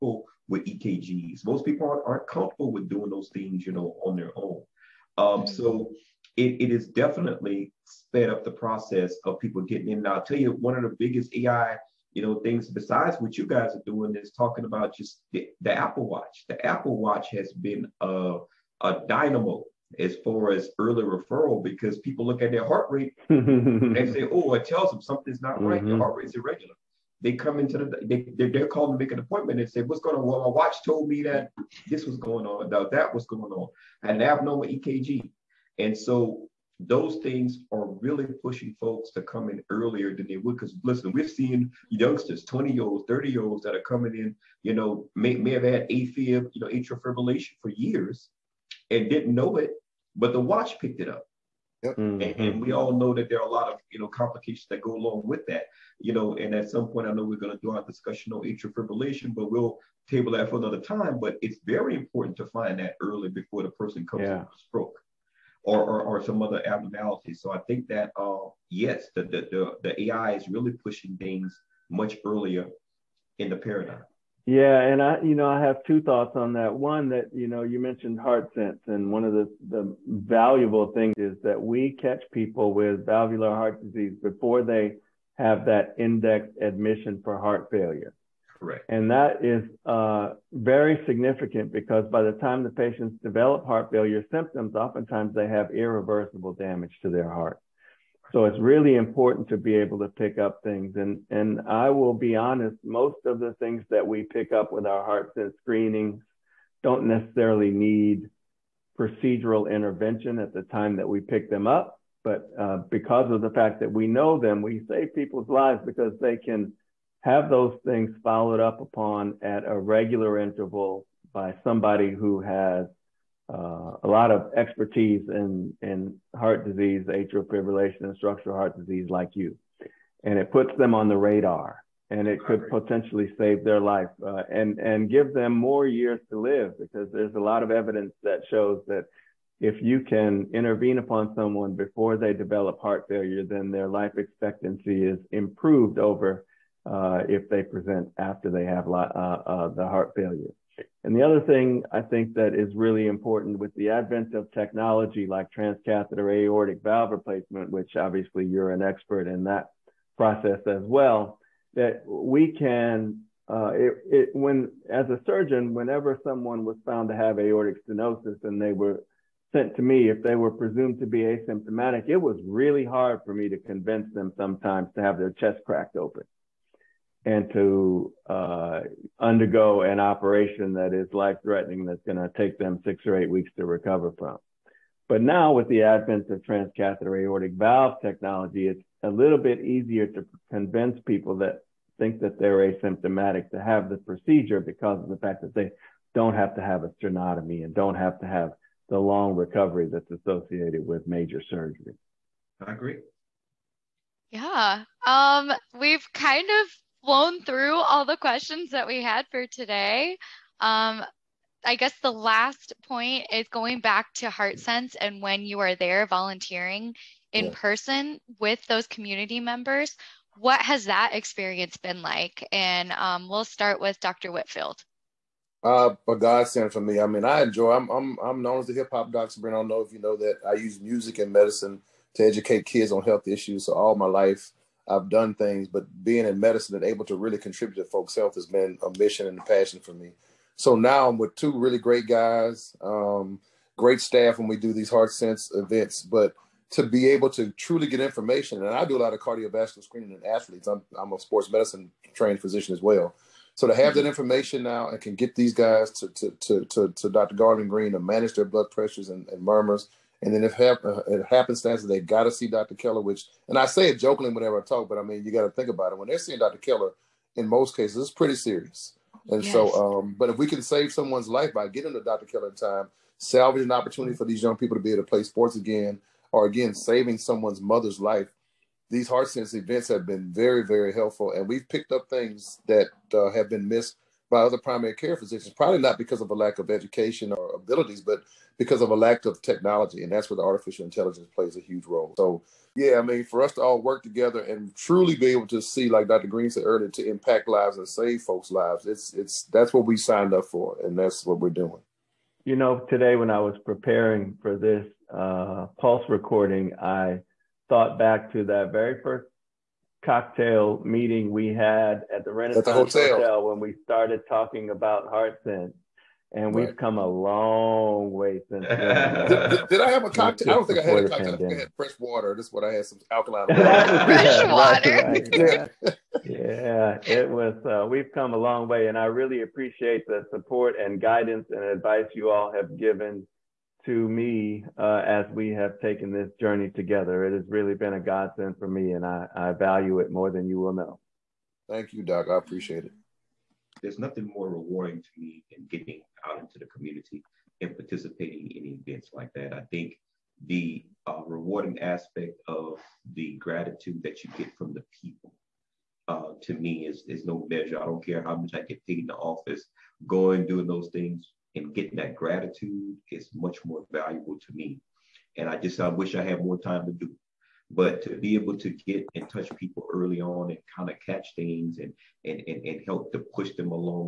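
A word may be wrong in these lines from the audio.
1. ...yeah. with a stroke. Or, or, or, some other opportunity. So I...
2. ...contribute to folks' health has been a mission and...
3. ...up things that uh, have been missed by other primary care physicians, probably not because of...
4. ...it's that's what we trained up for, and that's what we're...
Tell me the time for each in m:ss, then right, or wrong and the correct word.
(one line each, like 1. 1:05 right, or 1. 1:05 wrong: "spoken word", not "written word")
1. 1:04 wrong: "abnormality", not "opportunity"
2. 3:57 right
3. 4:41 right
4. 4:59 wrong: "signed", not "trained".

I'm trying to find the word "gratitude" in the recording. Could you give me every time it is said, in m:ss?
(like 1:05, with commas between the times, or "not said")
5:53, 6:02.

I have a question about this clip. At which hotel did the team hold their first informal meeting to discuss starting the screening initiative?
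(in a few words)
the Renaissance.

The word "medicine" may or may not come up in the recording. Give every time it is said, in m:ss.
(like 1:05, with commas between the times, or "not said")
3:51, 3:56, 4:11.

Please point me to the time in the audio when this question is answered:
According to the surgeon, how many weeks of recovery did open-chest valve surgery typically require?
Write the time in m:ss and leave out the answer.
3:02.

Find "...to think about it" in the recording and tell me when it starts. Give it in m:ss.
4:25.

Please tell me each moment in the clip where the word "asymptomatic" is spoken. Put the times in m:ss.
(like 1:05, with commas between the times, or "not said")
2:51, 3:12.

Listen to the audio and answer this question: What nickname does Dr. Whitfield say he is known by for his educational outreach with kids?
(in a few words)
the hip hop doctor.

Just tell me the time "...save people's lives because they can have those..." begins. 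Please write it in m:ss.
1:54.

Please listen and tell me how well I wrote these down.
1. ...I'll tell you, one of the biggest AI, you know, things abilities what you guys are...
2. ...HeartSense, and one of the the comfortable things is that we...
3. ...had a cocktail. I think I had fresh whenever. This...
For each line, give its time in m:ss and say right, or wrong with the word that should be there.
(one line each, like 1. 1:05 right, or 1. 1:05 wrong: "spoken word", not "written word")
1. 0:10 wrong: "besides", not "abilities"
2. 1:18 wrong: "valuable", not "comfortable"
3. 5:20 wrong: "water", not "whenever".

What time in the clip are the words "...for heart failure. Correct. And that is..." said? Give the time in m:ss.
1:27.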